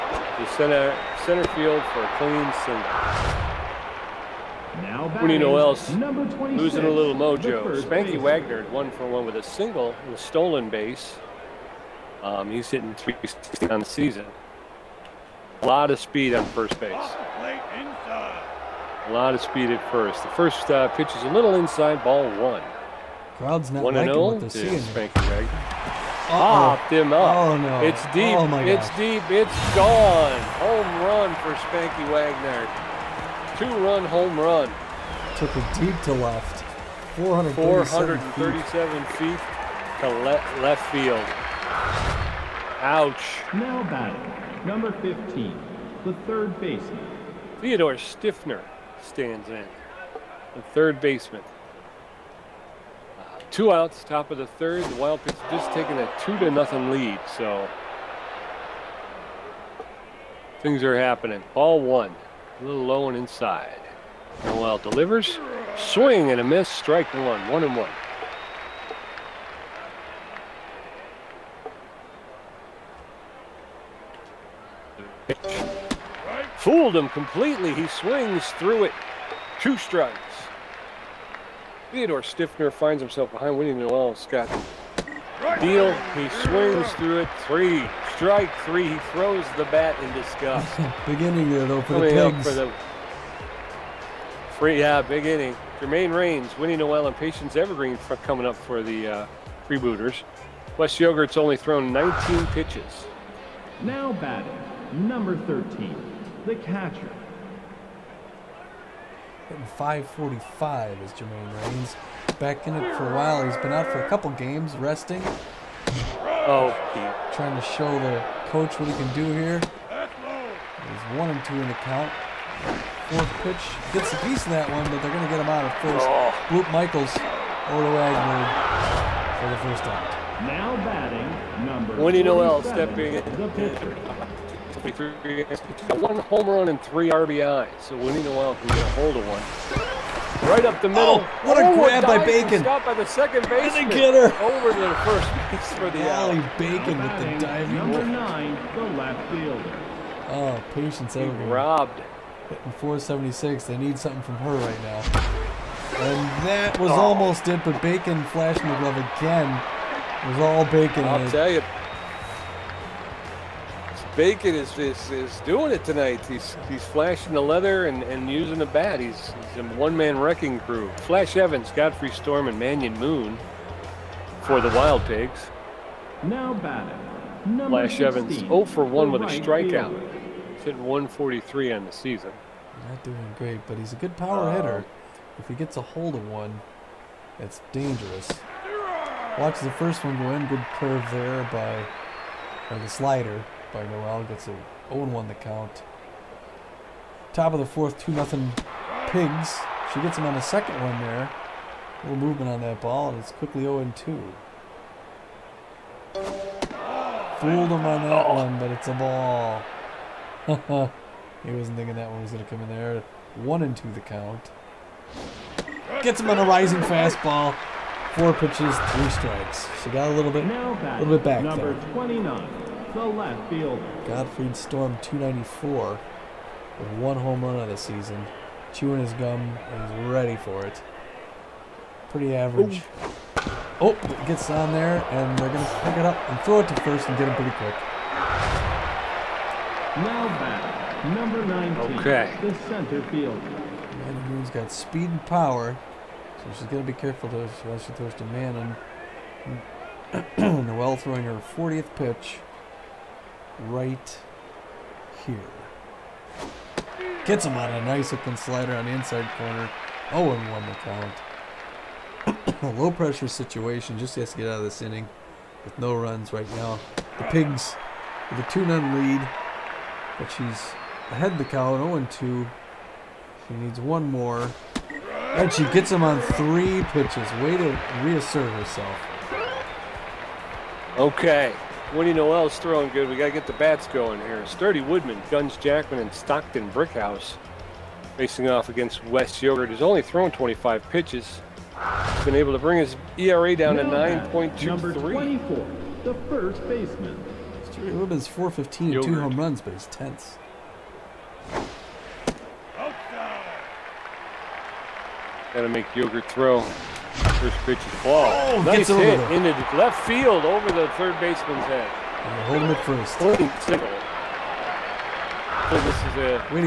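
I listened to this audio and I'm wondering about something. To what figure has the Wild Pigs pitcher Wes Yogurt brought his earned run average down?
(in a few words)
9.23.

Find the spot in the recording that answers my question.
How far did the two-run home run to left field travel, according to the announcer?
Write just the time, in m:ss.
0:38.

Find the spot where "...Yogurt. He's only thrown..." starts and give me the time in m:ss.
4:49.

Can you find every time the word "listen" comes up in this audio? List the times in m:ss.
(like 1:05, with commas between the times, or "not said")
not said.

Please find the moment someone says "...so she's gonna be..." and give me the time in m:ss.
4:06.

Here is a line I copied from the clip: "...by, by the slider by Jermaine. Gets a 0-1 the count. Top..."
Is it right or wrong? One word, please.
wrong.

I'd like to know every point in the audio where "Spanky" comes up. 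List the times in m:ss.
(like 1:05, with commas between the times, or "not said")
0:07, 0:24, 0:31.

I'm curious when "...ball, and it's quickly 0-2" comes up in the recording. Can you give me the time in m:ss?
3:22.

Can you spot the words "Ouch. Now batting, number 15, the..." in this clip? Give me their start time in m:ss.
0:42.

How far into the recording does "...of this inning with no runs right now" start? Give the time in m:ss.
4:24.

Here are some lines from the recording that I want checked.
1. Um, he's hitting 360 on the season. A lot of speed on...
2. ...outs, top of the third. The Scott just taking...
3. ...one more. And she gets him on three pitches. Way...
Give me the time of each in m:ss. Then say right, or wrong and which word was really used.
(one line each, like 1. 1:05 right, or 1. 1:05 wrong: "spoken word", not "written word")
1. 0:12 right
2. 0:53 wrong: "Wild", not "Scott"
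3. 4:33 right.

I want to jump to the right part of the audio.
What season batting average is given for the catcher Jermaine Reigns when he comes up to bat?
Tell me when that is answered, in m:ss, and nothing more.
1:49.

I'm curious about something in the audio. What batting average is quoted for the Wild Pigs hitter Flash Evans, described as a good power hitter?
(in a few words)
143.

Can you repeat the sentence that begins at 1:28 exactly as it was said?
He throws the bat in disgust.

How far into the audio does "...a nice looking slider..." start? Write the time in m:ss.
4:17.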